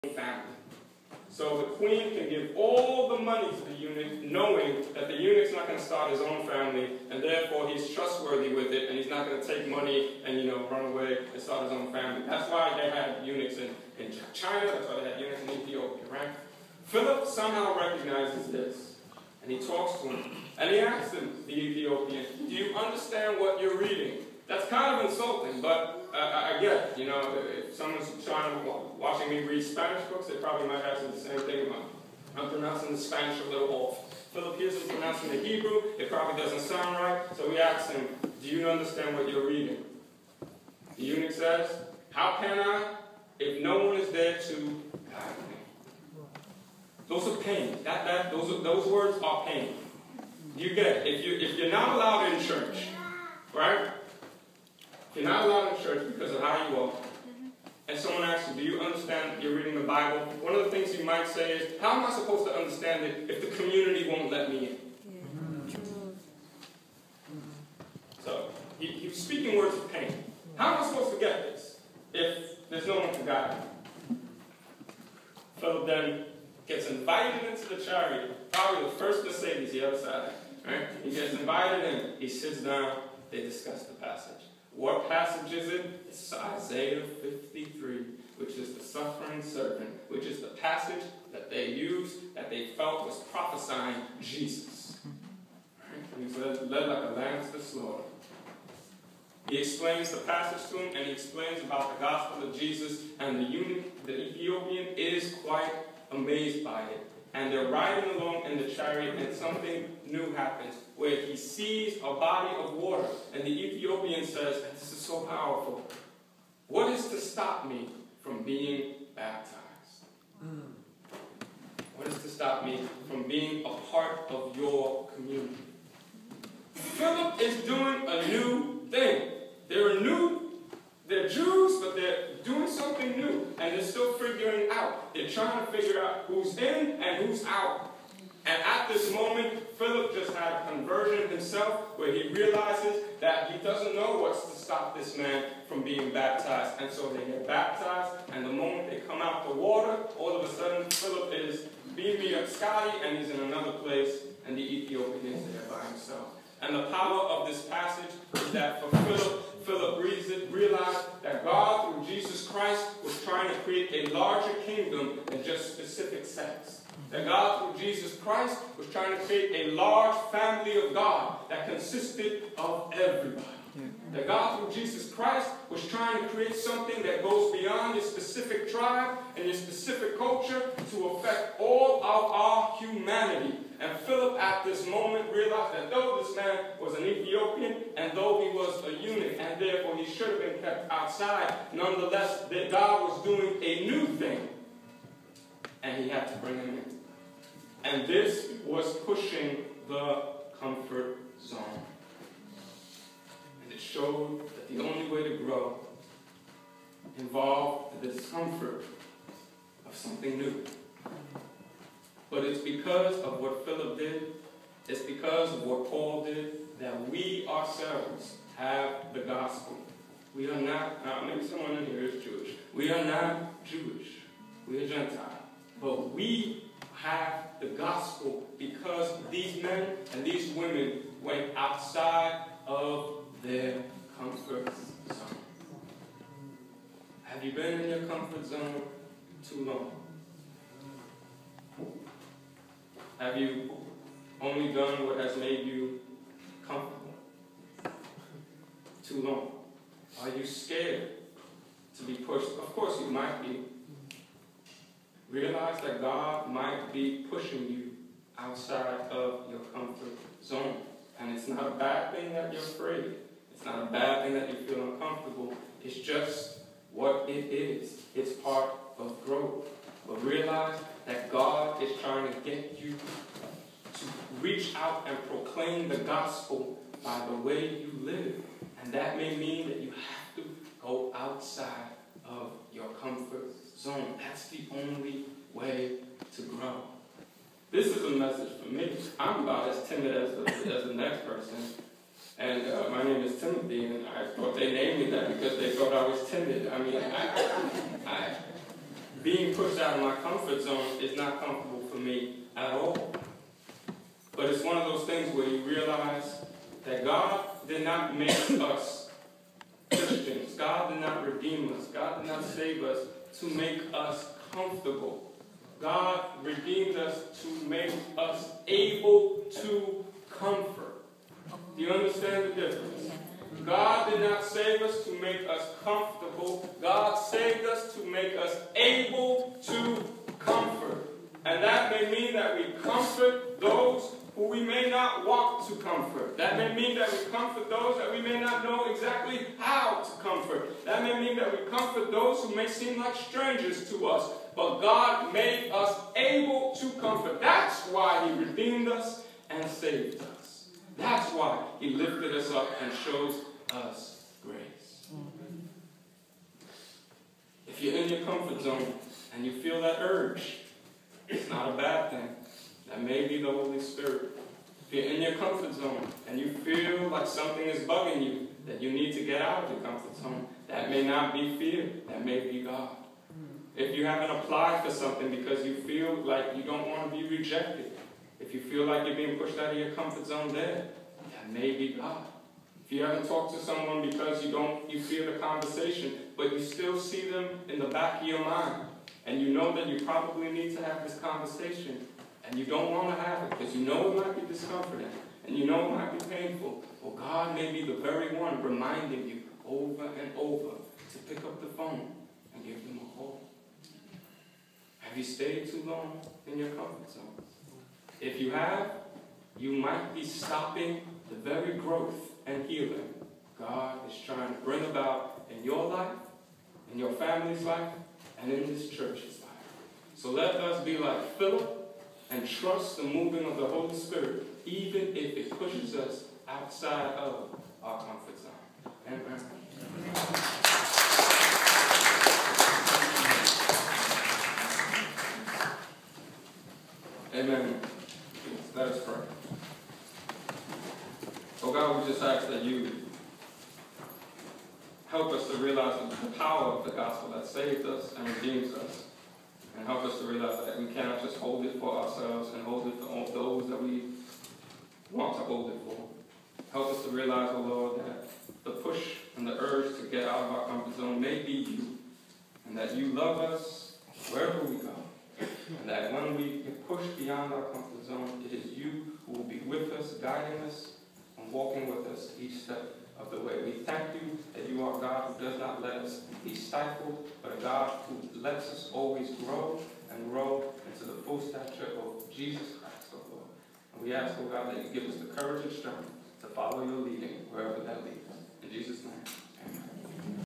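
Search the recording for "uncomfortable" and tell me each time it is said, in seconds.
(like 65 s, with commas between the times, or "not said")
264 s.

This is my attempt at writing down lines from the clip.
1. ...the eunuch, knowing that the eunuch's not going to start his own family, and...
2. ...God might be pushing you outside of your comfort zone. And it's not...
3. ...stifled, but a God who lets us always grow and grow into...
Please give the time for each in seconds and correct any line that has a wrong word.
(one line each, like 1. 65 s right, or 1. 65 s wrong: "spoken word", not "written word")
1. 3 s right
2. 256 s right
3. 476 s right.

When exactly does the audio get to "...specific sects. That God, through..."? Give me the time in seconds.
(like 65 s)
165 s.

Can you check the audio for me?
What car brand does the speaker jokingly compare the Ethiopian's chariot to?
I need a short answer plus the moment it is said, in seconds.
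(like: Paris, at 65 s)
Mercedes, at 79 s.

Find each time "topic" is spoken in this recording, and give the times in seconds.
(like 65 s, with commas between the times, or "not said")
not said.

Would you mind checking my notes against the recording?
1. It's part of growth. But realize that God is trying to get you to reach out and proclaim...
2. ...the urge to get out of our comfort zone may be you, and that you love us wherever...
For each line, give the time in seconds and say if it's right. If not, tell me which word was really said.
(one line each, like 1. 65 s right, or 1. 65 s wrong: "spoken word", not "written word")
1. 268 s right
2. 459 s right.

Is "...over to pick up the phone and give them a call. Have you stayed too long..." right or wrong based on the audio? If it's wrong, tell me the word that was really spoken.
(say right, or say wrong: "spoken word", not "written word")
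right.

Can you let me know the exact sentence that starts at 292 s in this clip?
And uh, my name is Timothy, and I thought they named me that because they thought I was timid.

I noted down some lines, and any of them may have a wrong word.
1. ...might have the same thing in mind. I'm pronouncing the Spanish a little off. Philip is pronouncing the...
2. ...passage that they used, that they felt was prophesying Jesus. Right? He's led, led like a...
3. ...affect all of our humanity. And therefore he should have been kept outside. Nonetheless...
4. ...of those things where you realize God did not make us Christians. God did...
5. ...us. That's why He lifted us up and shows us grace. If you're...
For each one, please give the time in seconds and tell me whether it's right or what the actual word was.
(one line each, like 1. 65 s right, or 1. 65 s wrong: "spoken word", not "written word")
1. 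30 s right
2. 90 s right
3. 181 s right
4. 304 s right
5. 350 s right.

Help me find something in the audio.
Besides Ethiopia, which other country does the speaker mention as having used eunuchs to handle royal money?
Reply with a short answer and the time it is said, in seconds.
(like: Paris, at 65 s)
China, at 14 s.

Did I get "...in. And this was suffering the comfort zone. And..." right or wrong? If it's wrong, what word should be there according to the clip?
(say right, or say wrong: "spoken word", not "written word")
wrong: "pushing", not "suffering".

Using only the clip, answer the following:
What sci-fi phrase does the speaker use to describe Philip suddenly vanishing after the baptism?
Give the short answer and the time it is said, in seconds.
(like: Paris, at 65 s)
beaming up Scotty, at 151 s.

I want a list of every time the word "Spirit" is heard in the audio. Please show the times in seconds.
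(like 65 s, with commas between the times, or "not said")
363 s, 423 s.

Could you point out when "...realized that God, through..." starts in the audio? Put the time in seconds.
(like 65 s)
160 s.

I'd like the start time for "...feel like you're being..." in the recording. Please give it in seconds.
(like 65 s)
378 s.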